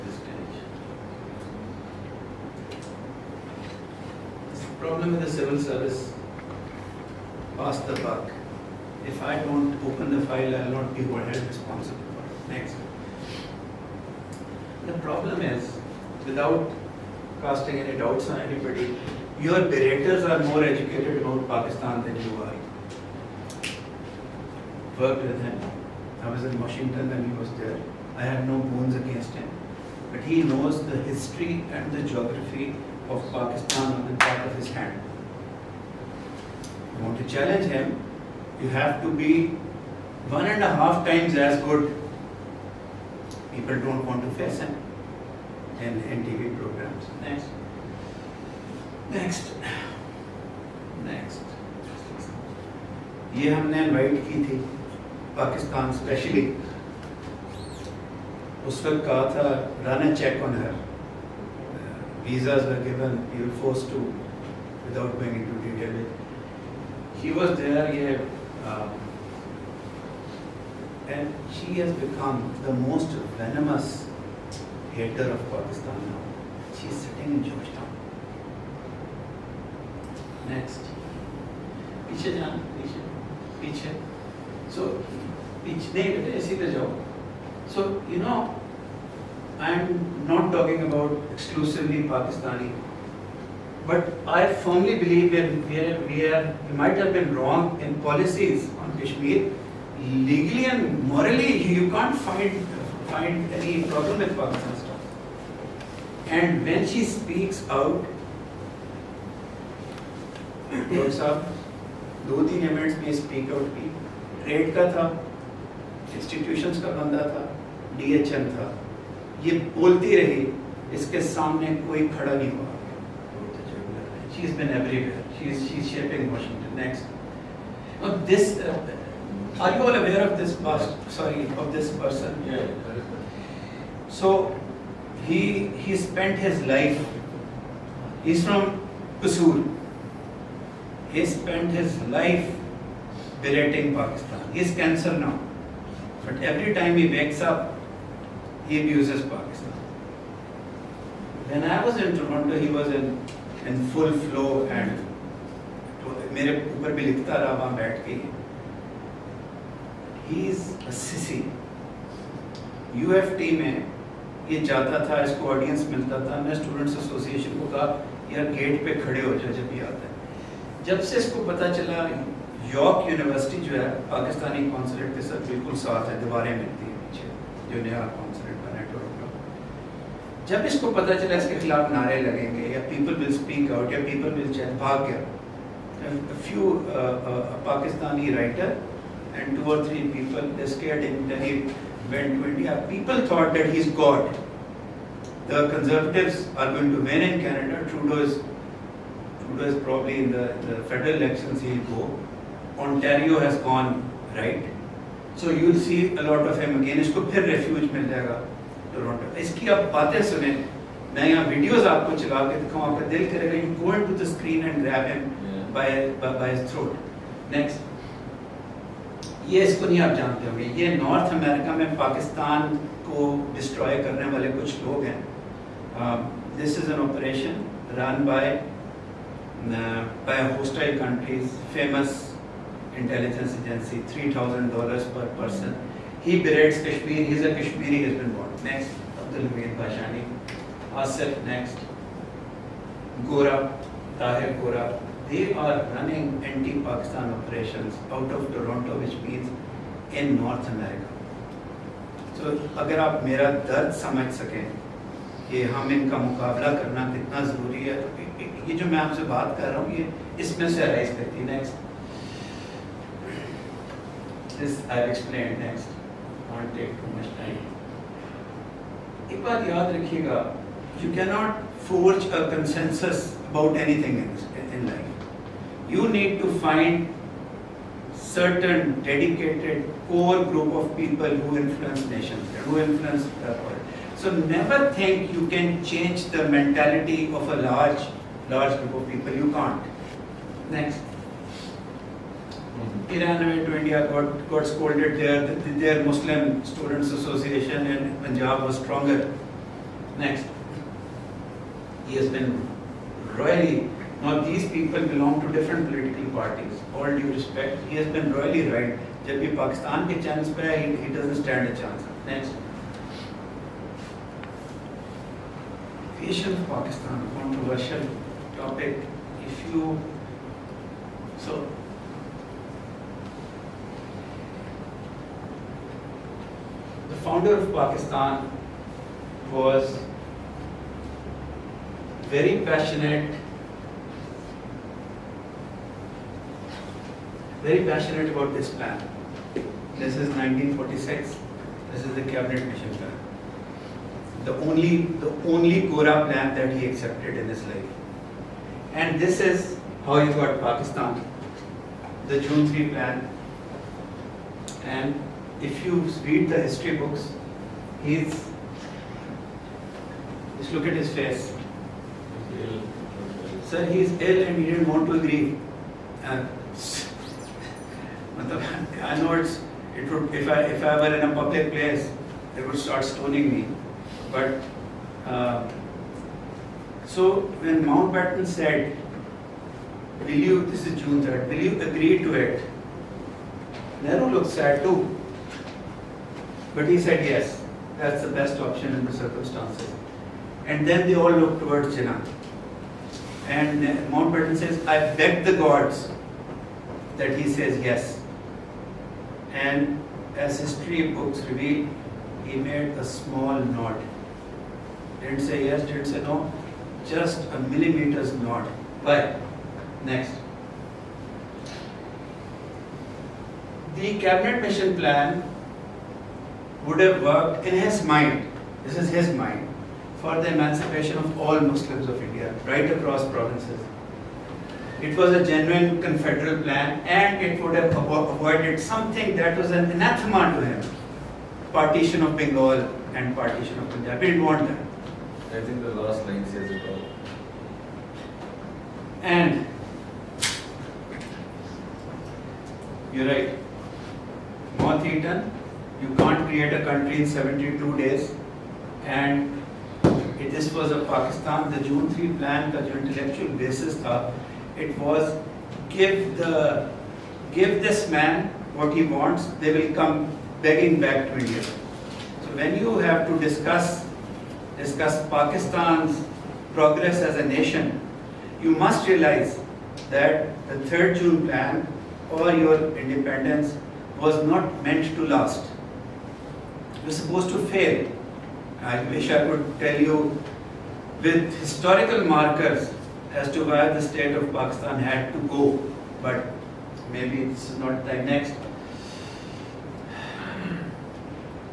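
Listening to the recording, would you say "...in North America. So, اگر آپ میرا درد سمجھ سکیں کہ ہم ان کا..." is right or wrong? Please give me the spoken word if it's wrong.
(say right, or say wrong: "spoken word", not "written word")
right.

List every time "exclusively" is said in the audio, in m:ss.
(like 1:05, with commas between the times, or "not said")
1:31.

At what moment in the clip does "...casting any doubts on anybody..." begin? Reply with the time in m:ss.
0:17.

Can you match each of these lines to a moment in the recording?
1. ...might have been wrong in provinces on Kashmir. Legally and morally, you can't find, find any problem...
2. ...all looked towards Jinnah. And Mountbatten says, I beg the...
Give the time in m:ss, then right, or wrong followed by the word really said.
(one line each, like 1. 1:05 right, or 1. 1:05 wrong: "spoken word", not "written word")
1. 1:36 wrong: "policies", not "provinces"
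2. 6:31 right.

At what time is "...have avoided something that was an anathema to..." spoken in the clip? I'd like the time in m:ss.
7:07.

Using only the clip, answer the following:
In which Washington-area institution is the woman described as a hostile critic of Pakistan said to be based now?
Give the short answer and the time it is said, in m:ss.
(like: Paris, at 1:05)
Georgetown, at 1:17.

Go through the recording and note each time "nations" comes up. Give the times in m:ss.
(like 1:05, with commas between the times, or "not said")
4:42, 7:47.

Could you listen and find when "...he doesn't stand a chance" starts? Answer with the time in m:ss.
5:11.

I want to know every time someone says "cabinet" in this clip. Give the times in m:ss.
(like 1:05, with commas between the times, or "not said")
5:42, 6:54.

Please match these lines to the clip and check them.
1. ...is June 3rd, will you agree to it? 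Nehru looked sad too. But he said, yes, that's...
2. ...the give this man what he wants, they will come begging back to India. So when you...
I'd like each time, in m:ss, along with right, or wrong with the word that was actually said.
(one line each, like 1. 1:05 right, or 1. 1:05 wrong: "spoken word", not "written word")
1. 6:20 right
2. 7:36 right.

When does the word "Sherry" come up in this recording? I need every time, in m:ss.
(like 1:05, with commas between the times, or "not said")
not said.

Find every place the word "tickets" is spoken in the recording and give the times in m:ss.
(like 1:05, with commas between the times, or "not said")
not said.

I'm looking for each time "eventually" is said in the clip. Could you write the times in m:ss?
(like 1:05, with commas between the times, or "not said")
not said.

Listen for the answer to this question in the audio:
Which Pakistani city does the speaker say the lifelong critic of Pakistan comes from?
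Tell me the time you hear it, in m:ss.
2:19.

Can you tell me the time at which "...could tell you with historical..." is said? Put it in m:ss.
7:59.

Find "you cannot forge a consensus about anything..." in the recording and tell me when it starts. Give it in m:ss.
4:31.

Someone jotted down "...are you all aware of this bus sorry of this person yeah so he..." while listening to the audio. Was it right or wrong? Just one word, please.
right.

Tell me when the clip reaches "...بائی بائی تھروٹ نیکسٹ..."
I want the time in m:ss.
3:35.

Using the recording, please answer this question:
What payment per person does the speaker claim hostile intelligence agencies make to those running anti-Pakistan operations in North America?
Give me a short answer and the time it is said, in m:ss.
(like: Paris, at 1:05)
$3,000, at 3:54.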